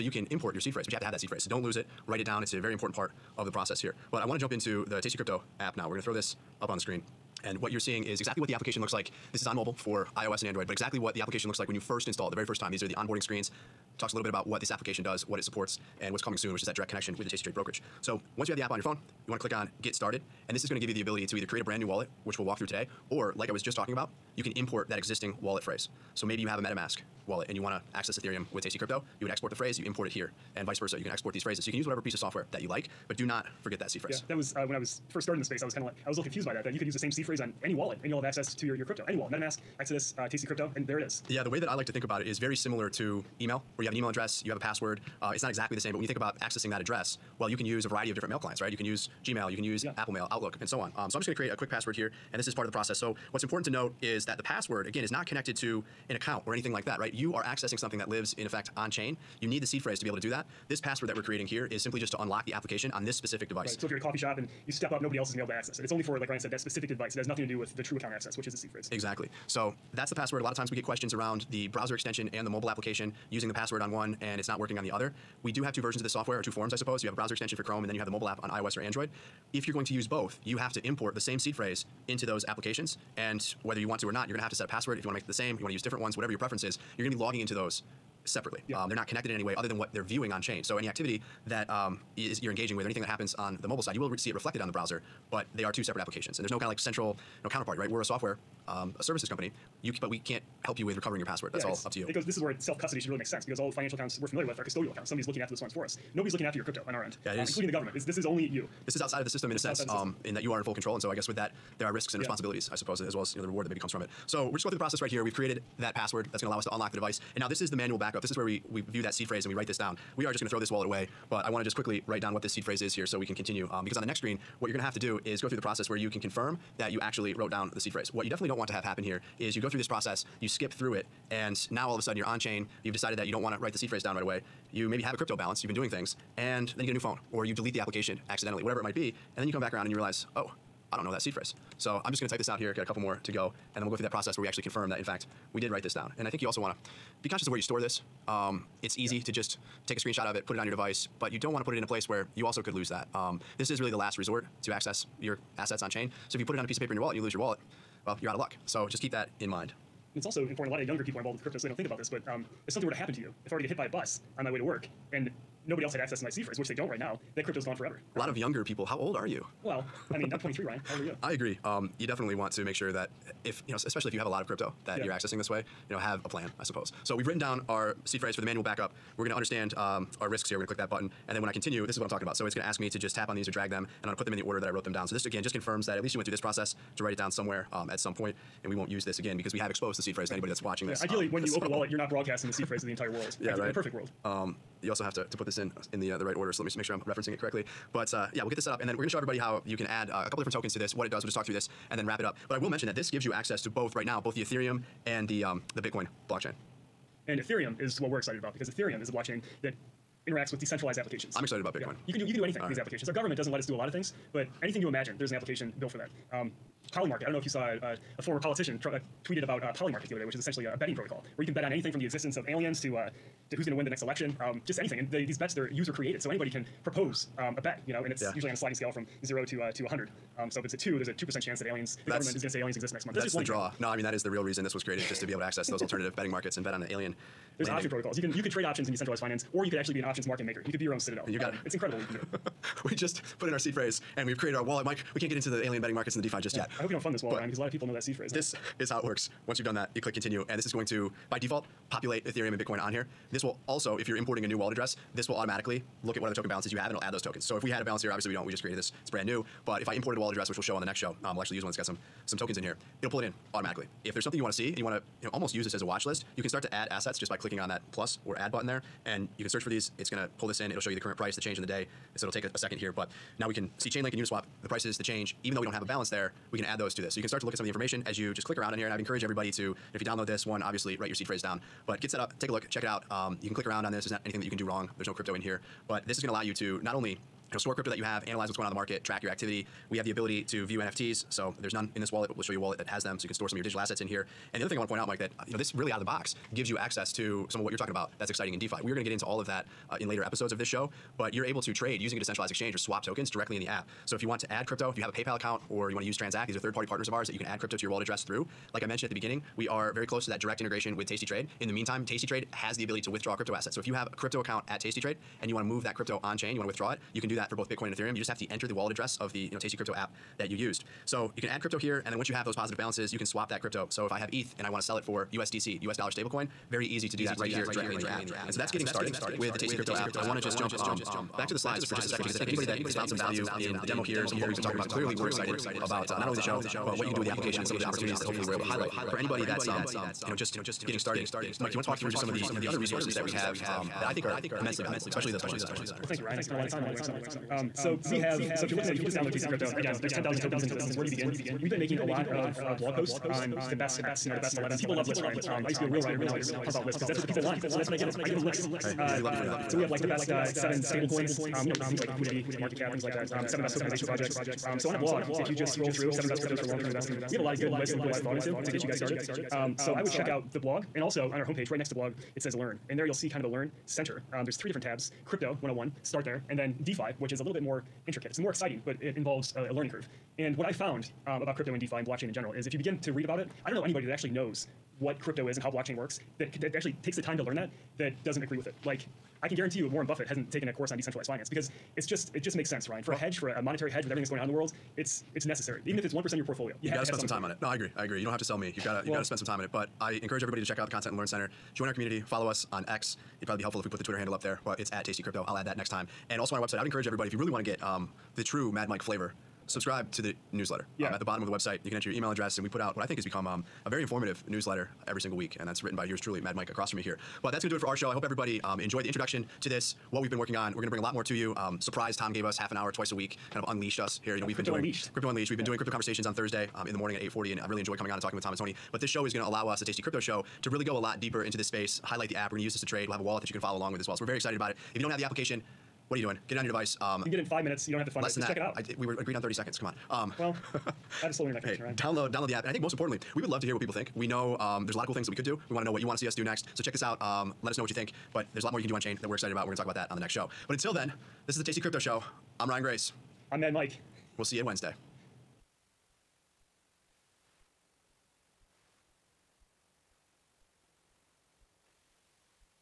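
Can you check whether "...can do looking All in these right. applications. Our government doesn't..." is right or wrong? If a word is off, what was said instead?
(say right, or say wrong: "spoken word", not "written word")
wrong: "anything", not "looking".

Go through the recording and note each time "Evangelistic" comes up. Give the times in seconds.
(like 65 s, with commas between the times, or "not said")
not said.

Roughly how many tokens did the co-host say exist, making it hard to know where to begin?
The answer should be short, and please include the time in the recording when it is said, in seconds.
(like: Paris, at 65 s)
10,000, at 350 s.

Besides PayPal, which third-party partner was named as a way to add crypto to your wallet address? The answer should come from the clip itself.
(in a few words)
Transact.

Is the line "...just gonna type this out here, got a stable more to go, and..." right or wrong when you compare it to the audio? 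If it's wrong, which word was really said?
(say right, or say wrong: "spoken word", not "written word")
wrong: "couple", not "stable".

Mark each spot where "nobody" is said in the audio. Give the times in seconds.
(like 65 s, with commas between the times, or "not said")
65 s, 106 s, 165 s.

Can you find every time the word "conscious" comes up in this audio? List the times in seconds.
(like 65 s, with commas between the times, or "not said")
147 s.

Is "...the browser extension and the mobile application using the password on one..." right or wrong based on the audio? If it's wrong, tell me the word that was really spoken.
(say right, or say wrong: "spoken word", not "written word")
right.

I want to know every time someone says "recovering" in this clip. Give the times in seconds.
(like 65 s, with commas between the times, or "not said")
100 s.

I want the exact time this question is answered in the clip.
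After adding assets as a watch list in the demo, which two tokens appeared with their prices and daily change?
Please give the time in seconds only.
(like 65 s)
273 s.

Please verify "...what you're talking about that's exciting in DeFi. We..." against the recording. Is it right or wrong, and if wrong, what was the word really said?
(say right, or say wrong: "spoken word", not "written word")
right.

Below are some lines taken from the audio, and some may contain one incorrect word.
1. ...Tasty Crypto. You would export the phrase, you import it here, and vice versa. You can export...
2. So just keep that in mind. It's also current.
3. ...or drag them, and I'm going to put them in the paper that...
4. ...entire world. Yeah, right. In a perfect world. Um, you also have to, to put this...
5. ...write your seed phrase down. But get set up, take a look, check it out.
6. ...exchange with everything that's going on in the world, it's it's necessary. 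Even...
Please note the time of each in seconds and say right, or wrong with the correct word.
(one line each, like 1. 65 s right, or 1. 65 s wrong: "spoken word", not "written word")
1. 28 s right
2. 158 s wrong: "important", not "current"
3. 183 s wrong: "order", not "paper"
4. 192 s right
5. 280 s right
6. 393 s wrong: "hedge", not "exchange".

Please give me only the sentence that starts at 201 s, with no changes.
We'll just talk through this, and then wrap it up.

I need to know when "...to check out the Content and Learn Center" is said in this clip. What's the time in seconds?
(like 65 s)
400 s.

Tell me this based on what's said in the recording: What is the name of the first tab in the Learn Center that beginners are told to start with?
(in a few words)
Crypto 101.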